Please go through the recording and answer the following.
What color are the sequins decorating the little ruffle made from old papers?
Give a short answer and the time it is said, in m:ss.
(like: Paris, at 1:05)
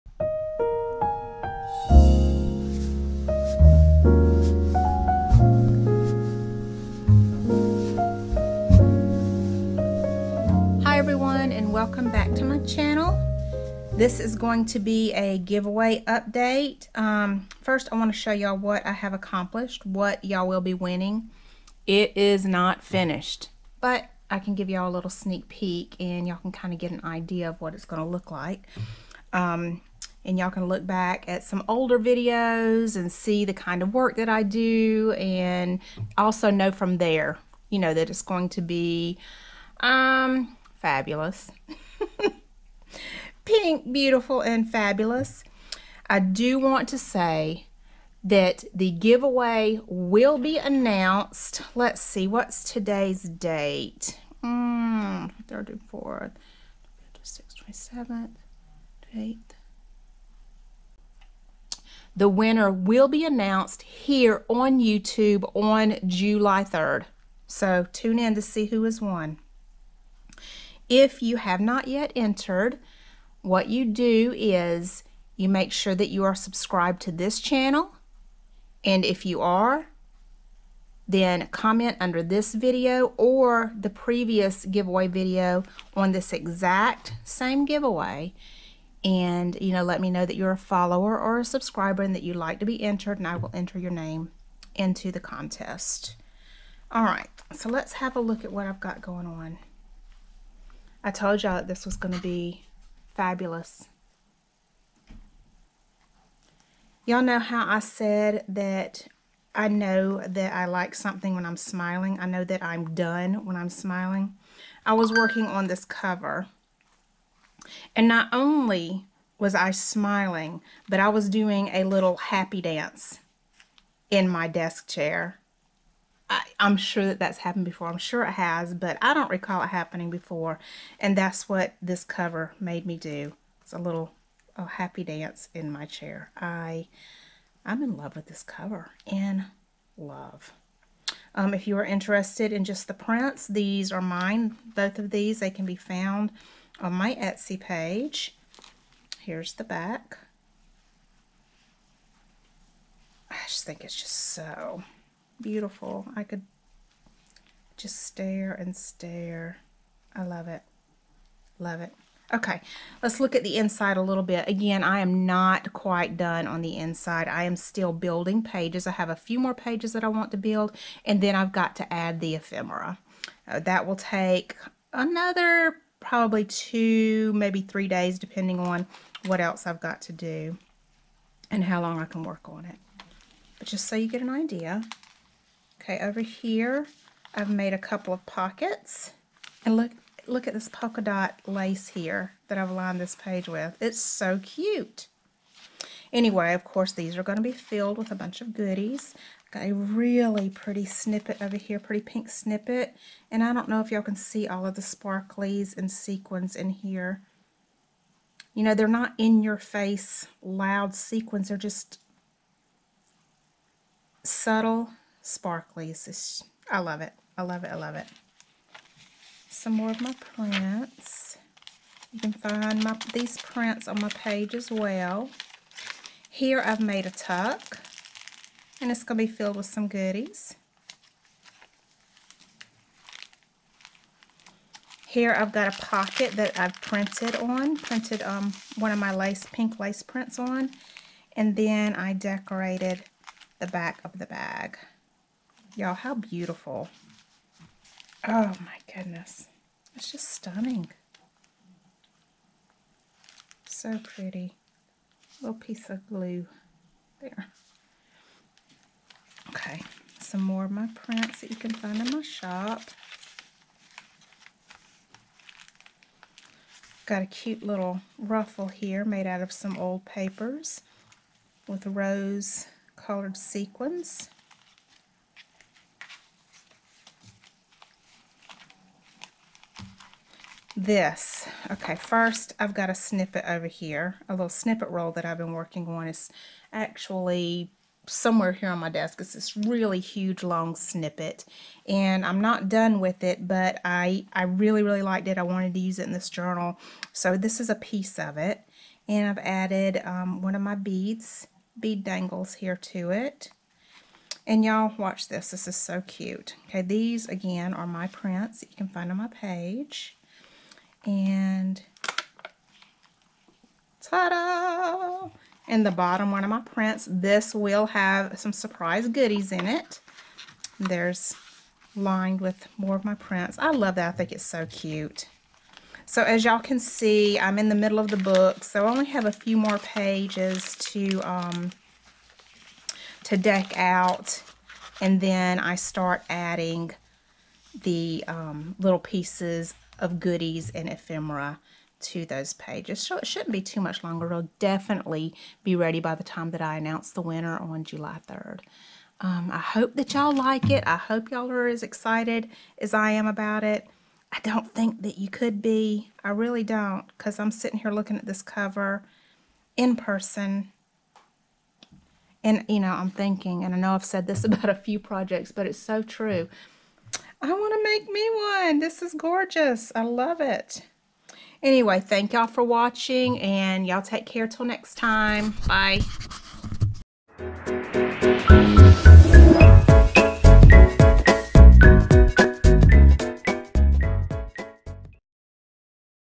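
Rose, at 4:31.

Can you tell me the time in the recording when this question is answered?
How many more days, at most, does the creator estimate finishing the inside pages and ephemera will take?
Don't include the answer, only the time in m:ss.
2:57.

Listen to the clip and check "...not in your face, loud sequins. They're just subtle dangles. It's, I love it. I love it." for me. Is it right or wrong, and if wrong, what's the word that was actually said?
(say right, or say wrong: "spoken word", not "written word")
wrong: "sparklies", not "dangles".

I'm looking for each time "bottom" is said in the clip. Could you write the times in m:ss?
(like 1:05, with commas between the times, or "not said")
5:15.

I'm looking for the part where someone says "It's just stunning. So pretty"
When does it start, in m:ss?
4:09.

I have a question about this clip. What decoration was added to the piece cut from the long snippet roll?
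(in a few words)
Bead dangles.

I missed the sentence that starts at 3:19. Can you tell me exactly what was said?
Got a really pretty snippet over here, pretty pink snippet.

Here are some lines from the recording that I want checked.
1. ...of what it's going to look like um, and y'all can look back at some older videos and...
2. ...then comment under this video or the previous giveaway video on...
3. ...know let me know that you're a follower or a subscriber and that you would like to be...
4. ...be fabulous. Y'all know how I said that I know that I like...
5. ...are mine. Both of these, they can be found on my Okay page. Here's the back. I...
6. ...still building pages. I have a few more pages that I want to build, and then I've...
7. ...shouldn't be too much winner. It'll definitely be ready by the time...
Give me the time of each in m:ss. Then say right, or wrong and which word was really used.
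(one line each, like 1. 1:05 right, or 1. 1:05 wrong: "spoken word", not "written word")
1. 0:27 right
2. 1:21 right
3. 1:29 right
4. 1:42 right
5. 2:23 wrong: "Etsy", not "Okay"
6. 2:47 right
7. 5:43 wrong: "longer", not "winner".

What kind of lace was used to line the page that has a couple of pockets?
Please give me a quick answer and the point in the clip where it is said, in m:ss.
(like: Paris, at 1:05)
Polka dot lace, at 3:10.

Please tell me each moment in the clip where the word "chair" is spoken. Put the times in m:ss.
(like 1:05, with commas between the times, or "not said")
2:04, 2:15.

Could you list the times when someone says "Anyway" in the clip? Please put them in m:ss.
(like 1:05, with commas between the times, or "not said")
3:16, 6:11.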